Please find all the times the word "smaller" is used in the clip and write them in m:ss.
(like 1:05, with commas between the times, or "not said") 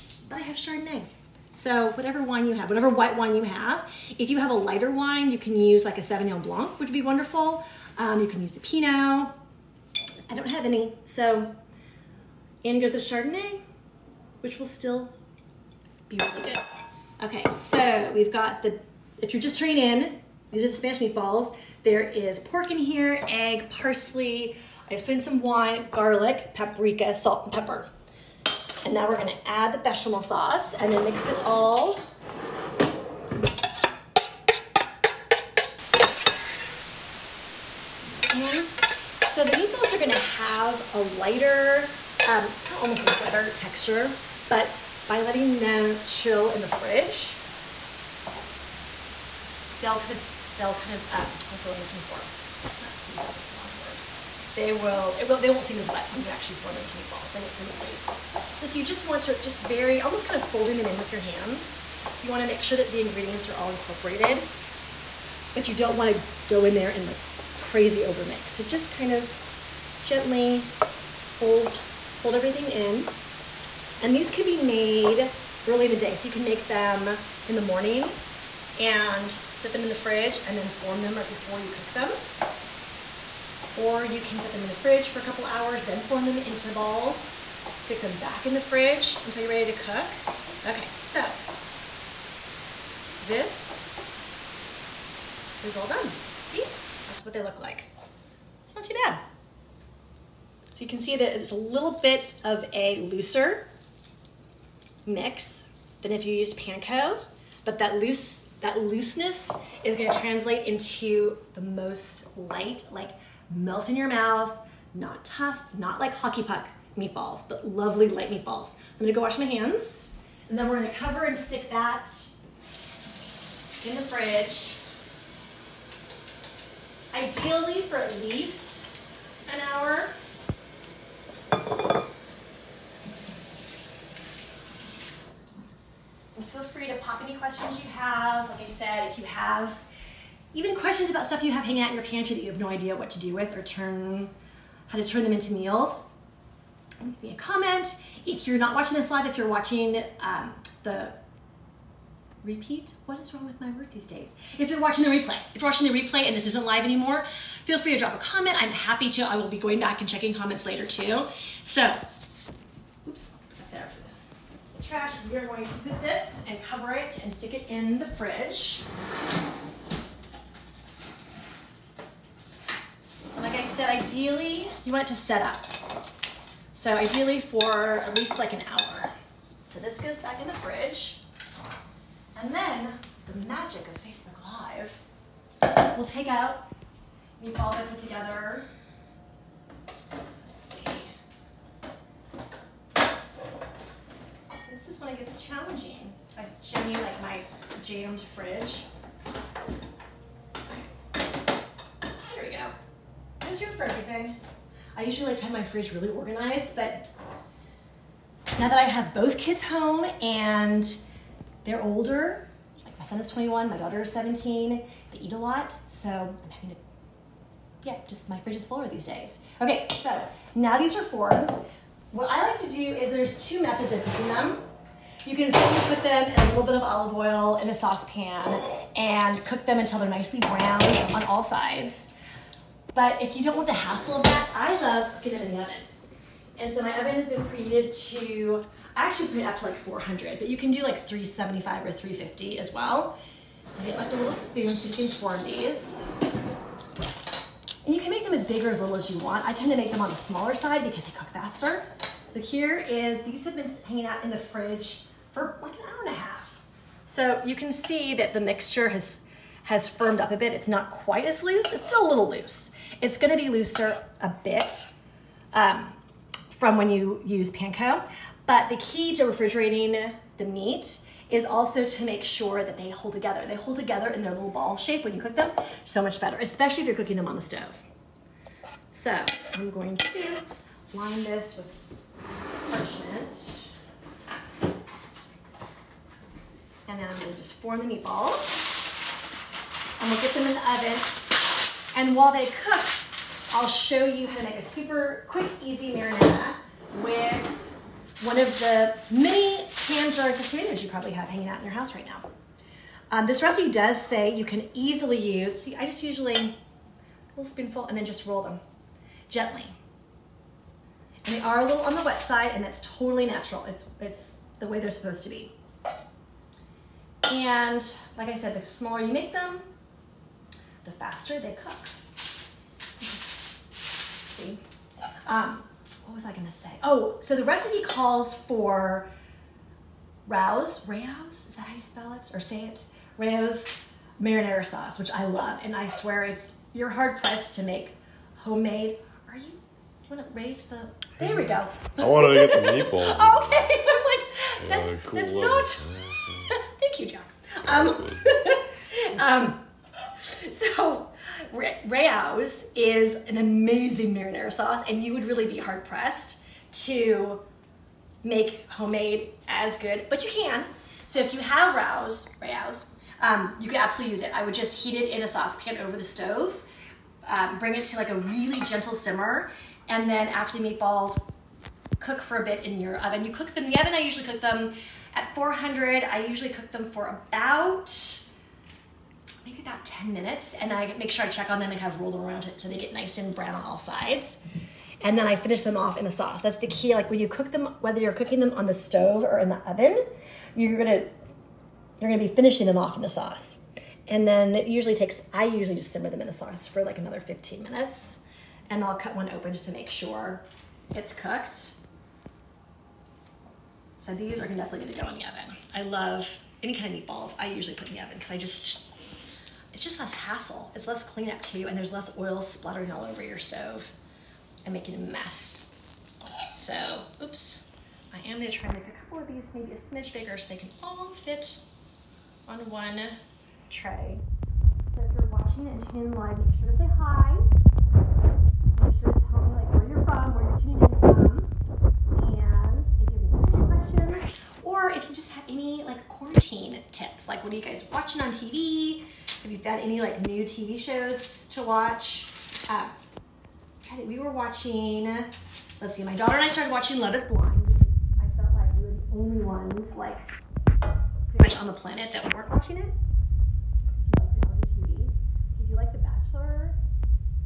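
4:10, 5:18.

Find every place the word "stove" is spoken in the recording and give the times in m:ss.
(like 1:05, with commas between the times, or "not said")
4:37, 6:06, 6:28, 6:53.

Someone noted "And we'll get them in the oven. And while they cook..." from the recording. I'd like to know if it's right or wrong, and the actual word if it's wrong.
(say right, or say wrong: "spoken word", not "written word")
right.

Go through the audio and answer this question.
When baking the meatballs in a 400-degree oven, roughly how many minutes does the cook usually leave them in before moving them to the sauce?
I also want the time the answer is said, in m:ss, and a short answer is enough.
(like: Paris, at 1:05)
10 minutes, at 6:19.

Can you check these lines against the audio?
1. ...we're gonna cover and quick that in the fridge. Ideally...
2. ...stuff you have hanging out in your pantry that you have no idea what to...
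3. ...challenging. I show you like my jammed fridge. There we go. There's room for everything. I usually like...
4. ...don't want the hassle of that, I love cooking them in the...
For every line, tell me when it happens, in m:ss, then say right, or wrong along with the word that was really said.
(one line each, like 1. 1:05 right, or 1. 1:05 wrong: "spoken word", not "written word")
1. 2:00 wrong: "stick", not "quick"
2. 2:21 right
3. 3:15 right
4. 3:53 right.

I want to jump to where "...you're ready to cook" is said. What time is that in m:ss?
1:29.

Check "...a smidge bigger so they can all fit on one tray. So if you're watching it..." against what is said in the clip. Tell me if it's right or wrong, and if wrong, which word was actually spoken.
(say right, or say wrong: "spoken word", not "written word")
right.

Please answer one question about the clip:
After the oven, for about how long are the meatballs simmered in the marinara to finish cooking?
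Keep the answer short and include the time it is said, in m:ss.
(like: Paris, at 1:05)
15 minutes, at 6:36.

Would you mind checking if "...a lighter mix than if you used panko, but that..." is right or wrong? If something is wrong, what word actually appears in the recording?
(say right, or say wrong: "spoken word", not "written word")
wrong: "looser", not "lighter".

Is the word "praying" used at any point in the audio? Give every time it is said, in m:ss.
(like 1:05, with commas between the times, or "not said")
not said.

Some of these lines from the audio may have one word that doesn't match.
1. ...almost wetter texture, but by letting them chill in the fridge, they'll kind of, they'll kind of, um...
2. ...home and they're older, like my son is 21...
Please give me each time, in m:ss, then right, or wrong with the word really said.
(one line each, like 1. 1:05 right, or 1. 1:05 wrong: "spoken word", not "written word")
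1. 0:42 right
2. 3:29 right.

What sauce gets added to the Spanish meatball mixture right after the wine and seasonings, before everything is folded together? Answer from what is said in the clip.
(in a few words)
Bechamel sauce.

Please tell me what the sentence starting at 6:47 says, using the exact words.
I usually put in the oven because I just, it's just less hassle.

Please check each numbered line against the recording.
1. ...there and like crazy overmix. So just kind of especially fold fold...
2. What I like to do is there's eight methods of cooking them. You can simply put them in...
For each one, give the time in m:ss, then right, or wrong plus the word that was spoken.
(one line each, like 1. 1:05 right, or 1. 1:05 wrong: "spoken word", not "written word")
1. 1:06 wrong: "gently", not "especially"
2. 3:42 wrong: "two", not "eight".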